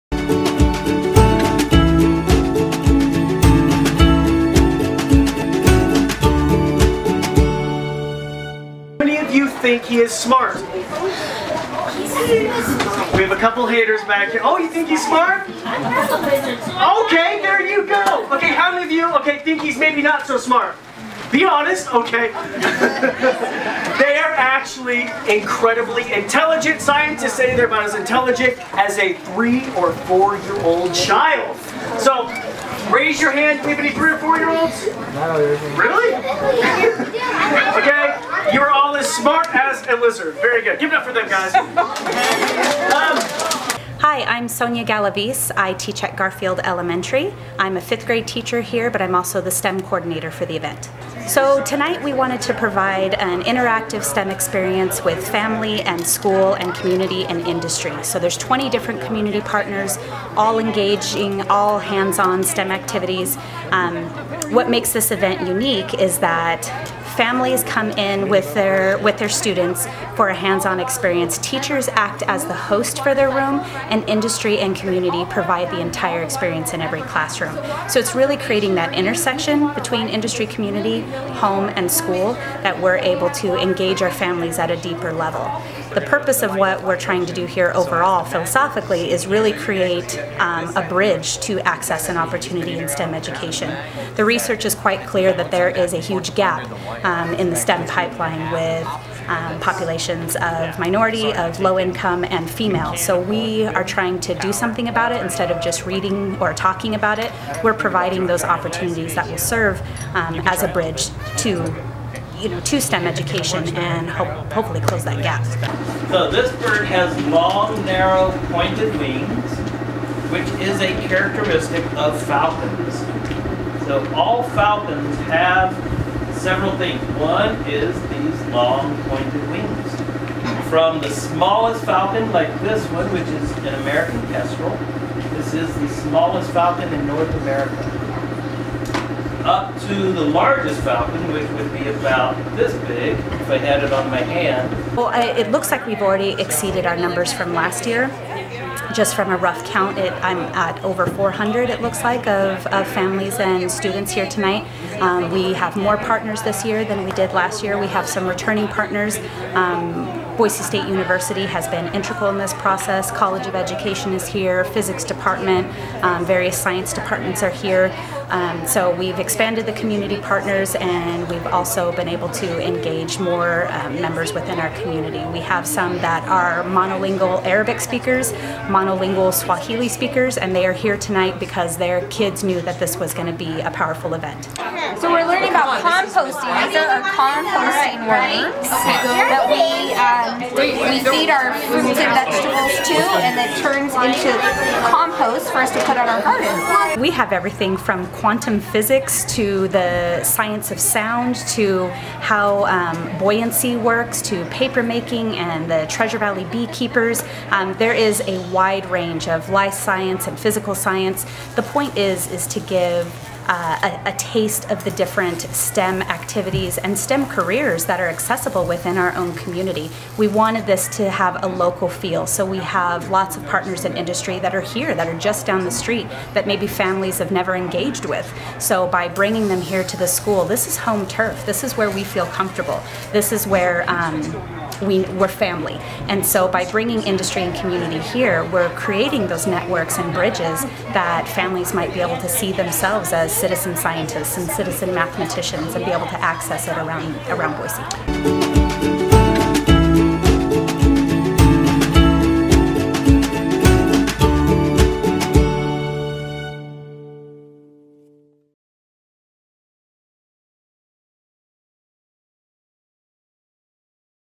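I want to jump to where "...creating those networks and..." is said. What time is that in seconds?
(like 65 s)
238 s.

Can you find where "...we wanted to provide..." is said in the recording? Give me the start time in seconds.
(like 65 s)
52 s.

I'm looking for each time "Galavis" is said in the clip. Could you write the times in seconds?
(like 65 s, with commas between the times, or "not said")
44 s.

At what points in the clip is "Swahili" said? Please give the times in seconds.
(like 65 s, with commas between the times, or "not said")
179 s.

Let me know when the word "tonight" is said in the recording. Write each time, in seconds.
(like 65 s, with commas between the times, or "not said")
51 s, 154 s, 180 s.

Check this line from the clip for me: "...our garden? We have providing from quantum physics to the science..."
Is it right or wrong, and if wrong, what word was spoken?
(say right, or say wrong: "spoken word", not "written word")
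wrong: "everything", not "providing".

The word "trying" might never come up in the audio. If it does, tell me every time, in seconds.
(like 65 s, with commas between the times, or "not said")
86 s, 103 s.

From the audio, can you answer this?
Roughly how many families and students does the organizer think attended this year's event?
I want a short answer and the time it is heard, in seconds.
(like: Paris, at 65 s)
over 400, at 150 s.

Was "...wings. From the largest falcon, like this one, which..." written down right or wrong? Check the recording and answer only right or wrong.
wrong.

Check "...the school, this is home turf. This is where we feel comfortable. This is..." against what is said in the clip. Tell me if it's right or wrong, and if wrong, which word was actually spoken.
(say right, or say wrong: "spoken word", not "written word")
right.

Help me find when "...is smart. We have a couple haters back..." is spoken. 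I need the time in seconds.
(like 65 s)
9 s.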